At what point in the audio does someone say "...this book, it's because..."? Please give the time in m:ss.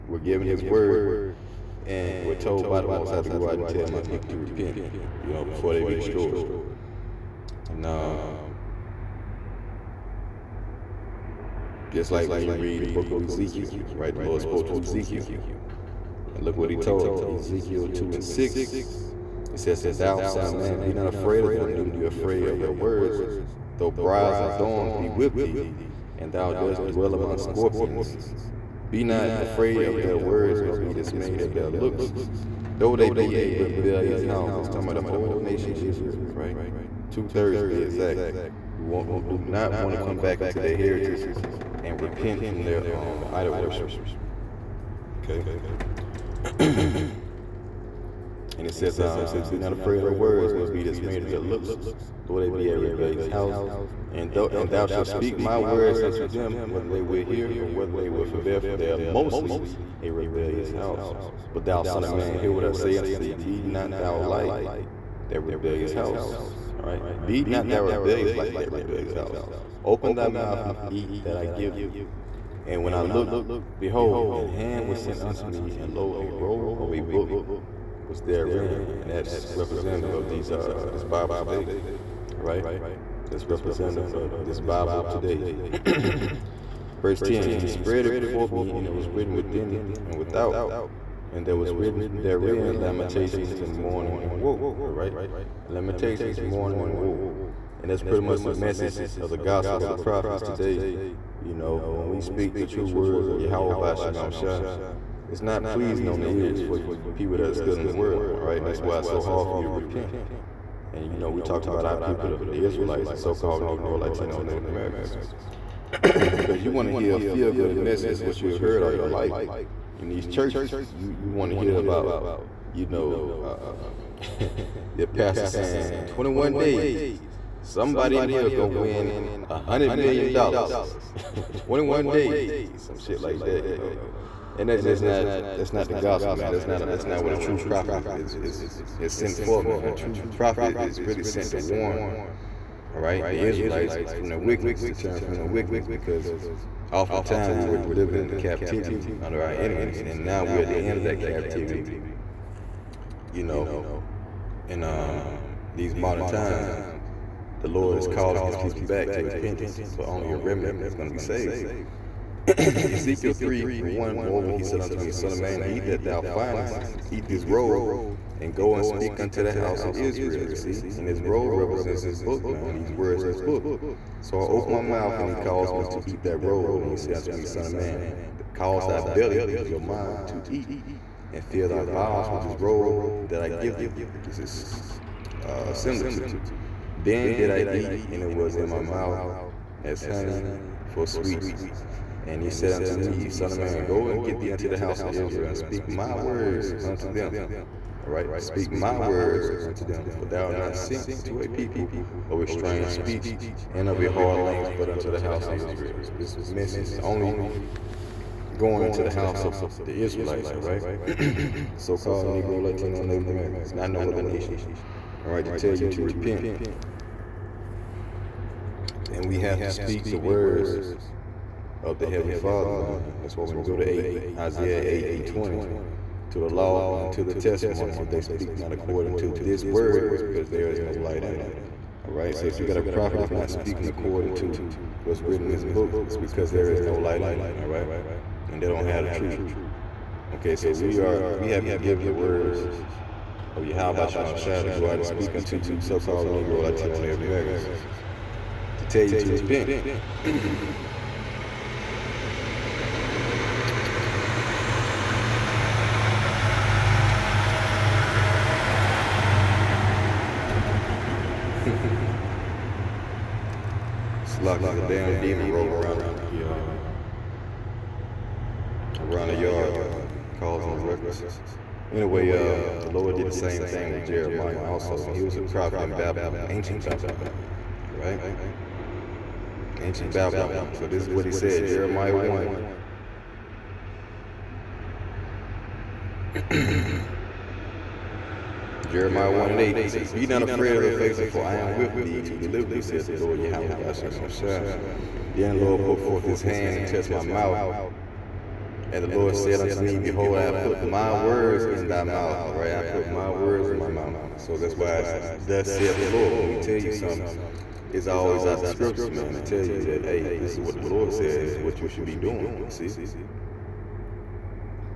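3:55.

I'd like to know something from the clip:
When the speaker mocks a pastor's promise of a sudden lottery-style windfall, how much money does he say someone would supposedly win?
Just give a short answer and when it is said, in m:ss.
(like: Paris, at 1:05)
100 million dollars, at 2:09.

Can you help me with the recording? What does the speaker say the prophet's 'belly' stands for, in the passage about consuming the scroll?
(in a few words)
mind.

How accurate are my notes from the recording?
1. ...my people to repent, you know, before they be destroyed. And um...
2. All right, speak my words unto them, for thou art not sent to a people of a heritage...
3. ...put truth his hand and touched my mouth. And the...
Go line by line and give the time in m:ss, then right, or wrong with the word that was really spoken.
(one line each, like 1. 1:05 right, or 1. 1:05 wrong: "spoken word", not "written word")
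1. 0:03 right
2. 3:18 wrong: "strange", not "heritage"
3. 4:55 wrong: "forth", not "truth".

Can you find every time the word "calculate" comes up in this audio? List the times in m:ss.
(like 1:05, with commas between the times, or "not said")
not said.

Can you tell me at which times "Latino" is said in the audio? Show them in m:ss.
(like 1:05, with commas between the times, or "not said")
1:53, 3:32, 4:06.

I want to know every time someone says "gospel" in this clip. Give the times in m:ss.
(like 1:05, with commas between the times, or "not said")
1:39, 2:15.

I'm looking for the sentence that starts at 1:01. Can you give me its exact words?
But thou, son of man, hear what I say unto thee: Be not thou like that rebellious house.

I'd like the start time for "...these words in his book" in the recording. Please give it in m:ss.
2:52.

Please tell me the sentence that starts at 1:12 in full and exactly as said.
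And when I looked, behold, an hand was sent unto me, and lo, a roll of a book was therein.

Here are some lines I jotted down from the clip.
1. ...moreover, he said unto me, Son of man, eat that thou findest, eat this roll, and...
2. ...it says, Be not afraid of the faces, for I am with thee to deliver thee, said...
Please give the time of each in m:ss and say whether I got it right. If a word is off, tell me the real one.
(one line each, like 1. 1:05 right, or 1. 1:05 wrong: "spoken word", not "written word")
1. 2:44 right
2. 4:49 right.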